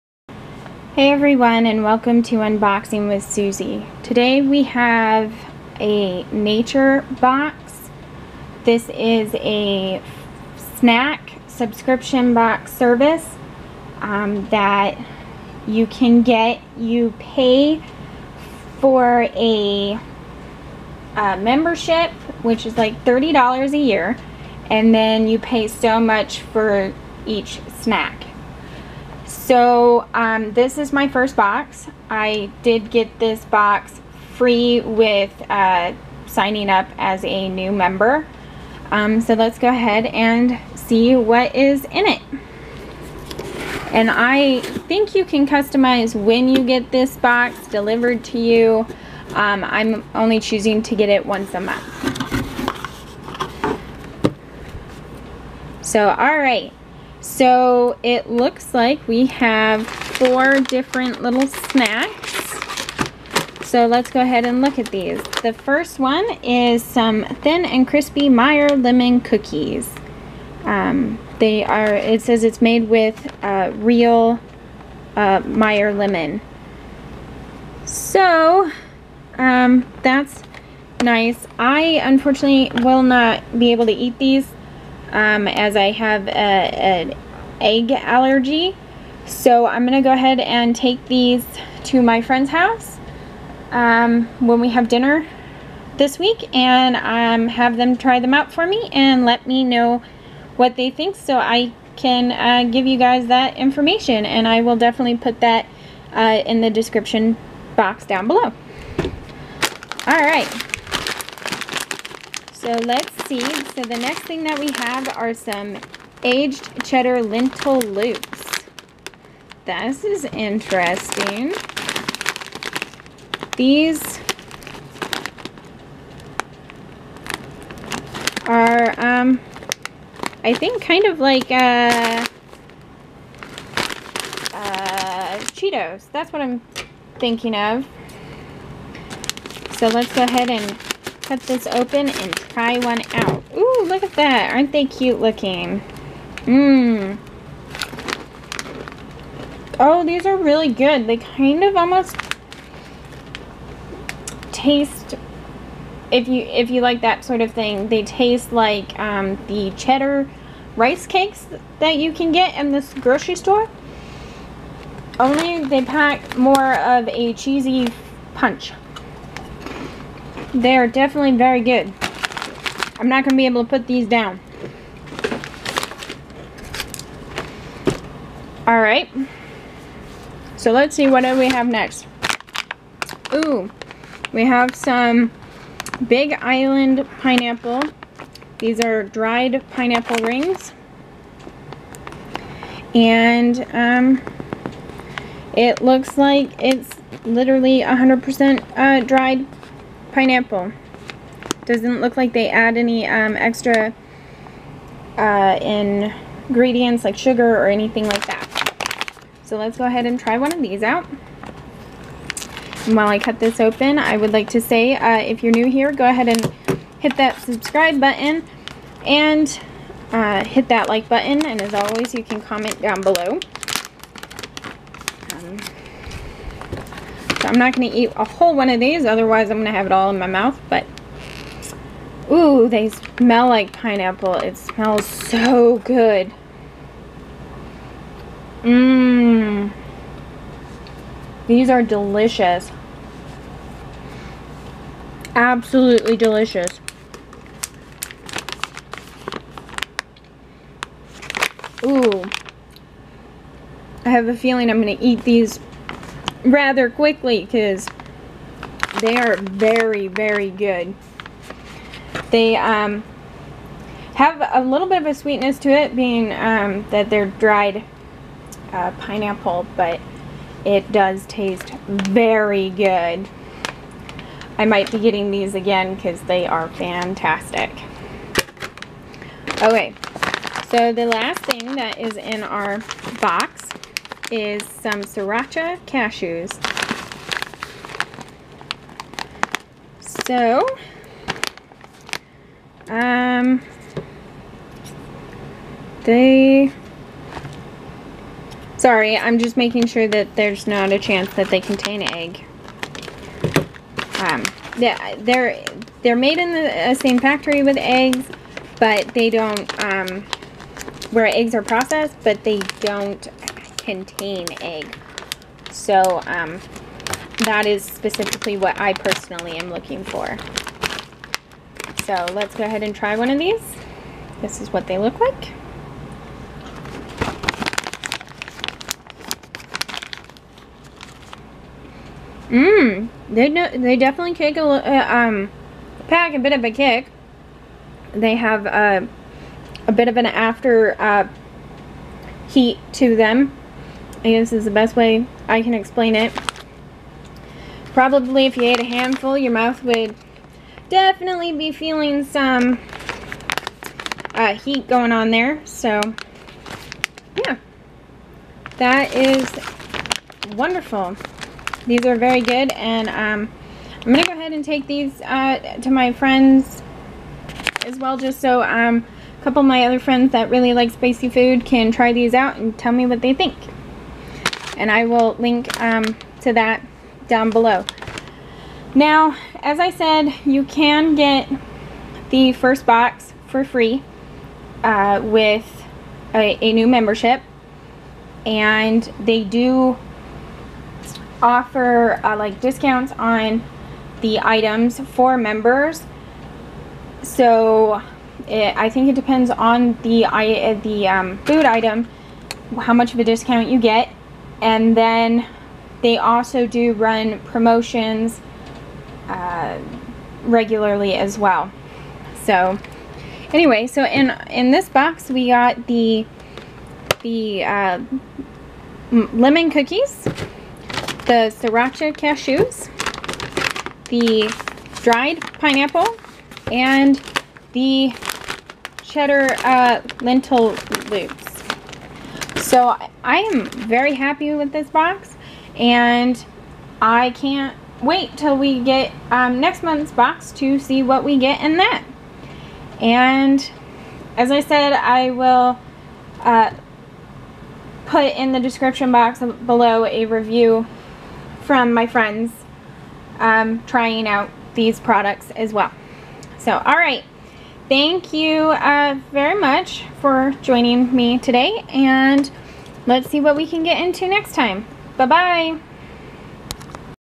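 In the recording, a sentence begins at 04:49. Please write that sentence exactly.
So, um, they, sorry, I'm just making sure that there's not a chance that they contain egg.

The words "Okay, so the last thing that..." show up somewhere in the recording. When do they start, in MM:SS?
04:39.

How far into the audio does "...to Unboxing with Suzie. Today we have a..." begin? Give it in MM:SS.
00:02.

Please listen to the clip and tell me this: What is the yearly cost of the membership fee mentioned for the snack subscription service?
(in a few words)
$30.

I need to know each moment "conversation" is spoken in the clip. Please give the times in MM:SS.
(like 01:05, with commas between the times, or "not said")
not said.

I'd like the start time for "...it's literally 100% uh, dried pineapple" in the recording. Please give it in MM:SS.
03:16.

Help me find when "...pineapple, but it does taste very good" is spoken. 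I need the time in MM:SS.
04:28.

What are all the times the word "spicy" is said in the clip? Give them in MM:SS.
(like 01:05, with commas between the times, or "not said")
06:10.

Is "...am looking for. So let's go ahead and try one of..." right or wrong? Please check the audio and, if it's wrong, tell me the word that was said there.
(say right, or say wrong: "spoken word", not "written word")
right.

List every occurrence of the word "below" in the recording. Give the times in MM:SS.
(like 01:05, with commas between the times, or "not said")
01:48, 03:43, 06:17, 07:29.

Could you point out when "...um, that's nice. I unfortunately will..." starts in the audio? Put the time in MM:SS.
01:19.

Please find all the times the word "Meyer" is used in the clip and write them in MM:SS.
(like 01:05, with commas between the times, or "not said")
01:08, 01:15.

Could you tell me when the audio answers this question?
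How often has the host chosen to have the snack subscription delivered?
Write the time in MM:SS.
00:51.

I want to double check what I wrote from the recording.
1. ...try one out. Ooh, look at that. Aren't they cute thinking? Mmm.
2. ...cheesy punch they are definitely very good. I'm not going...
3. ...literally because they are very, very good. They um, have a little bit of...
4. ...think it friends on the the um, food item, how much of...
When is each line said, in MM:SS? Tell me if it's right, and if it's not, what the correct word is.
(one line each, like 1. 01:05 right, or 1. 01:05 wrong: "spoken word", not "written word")
1. 02:22 wrong: "looking", not "thinking"
2. 02:47 right
3. 04:16 wrong: "quickly", not "literally"
4. 06:38 wrong: "depends", not "friends".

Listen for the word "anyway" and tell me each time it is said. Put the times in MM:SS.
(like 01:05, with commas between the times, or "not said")
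06:53.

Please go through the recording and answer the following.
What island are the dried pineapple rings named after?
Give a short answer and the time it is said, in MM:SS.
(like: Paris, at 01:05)
Big Island, at 03:06.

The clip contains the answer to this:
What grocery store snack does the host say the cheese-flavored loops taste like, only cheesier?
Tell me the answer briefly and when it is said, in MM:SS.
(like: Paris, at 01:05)
Cheddar rice cakes, at 02:39.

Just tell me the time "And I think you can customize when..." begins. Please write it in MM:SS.
00:43.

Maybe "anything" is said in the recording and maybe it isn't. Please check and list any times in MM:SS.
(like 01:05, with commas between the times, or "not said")
03:27.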